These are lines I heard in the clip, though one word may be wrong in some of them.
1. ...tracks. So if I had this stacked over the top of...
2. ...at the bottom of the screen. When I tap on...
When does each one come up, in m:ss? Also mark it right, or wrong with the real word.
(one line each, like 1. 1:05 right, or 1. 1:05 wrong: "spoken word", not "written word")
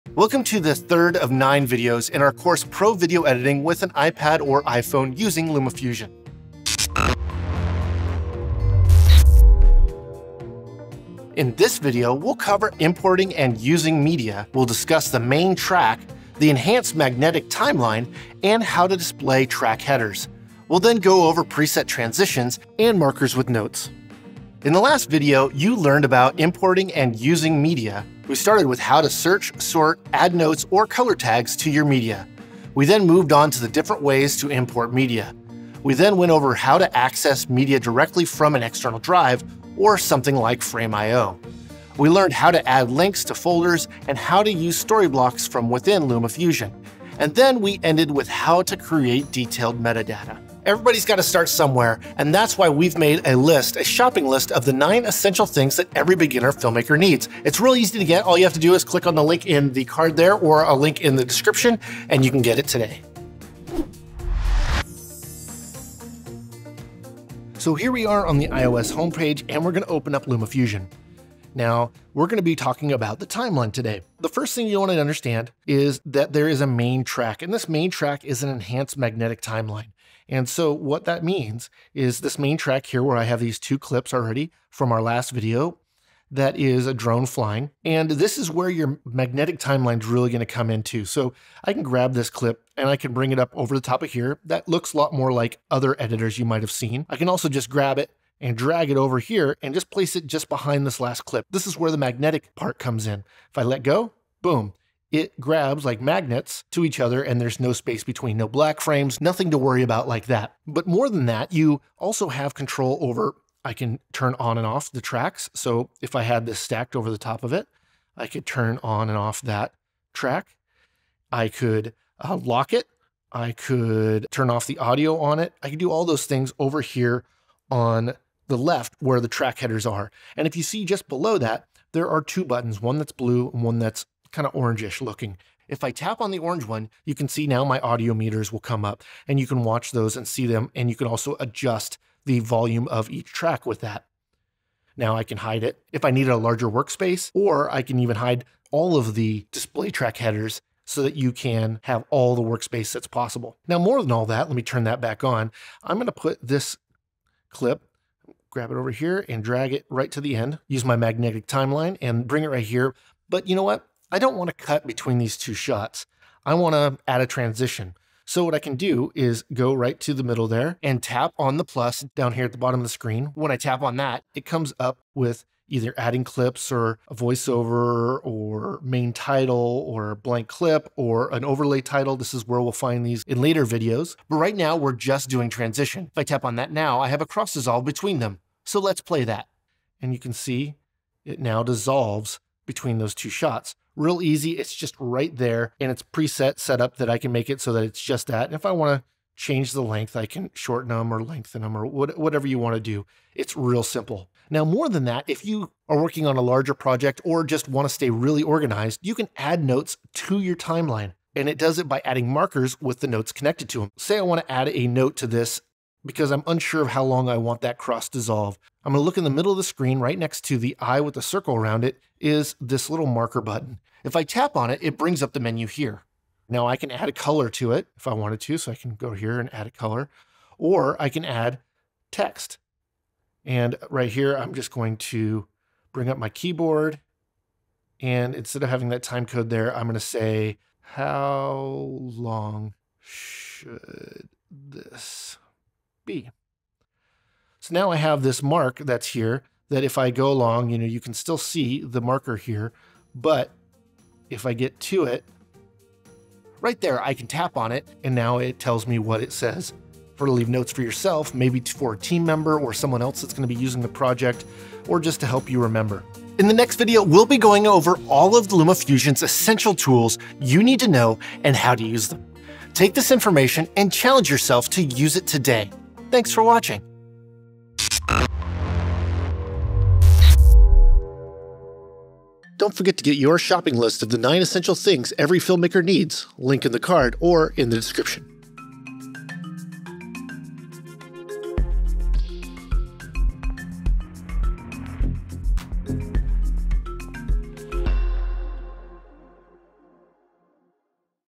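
1. 1:55 right
2. 2:52 right.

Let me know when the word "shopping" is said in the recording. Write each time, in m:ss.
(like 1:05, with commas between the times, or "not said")
0:53, 4:43.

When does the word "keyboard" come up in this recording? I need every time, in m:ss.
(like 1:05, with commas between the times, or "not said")
3:56.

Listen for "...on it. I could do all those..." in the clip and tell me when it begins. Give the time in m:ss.
2:05.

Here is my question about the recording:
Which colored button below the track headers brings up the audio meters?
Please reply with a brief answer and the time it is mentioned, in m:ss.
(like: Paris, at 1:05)
Orange, at 2:16.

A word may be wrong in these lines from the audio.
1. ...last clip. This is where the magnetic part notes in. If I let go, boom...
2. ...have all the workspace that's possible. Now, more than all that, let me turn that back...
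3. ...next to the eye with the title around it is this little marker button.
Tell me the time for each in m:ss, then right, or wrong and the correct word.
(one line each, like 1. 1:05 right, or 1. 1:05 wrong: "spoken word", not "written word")
1. 1:40 wrong: "comes", not "notes"
2. 2:31 right
3. 3:40 wrong: "circle", not "title".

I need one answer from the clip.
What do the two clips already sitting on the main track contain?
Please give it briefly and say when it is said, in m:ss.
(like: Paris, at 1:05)
A drone flying, at 1:26.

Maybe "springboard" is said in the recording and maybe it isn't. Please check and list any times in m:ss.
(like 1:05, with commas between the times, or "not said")
not said.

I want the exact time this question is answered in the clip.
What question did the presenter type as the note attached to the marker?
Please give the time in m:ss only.
4:00.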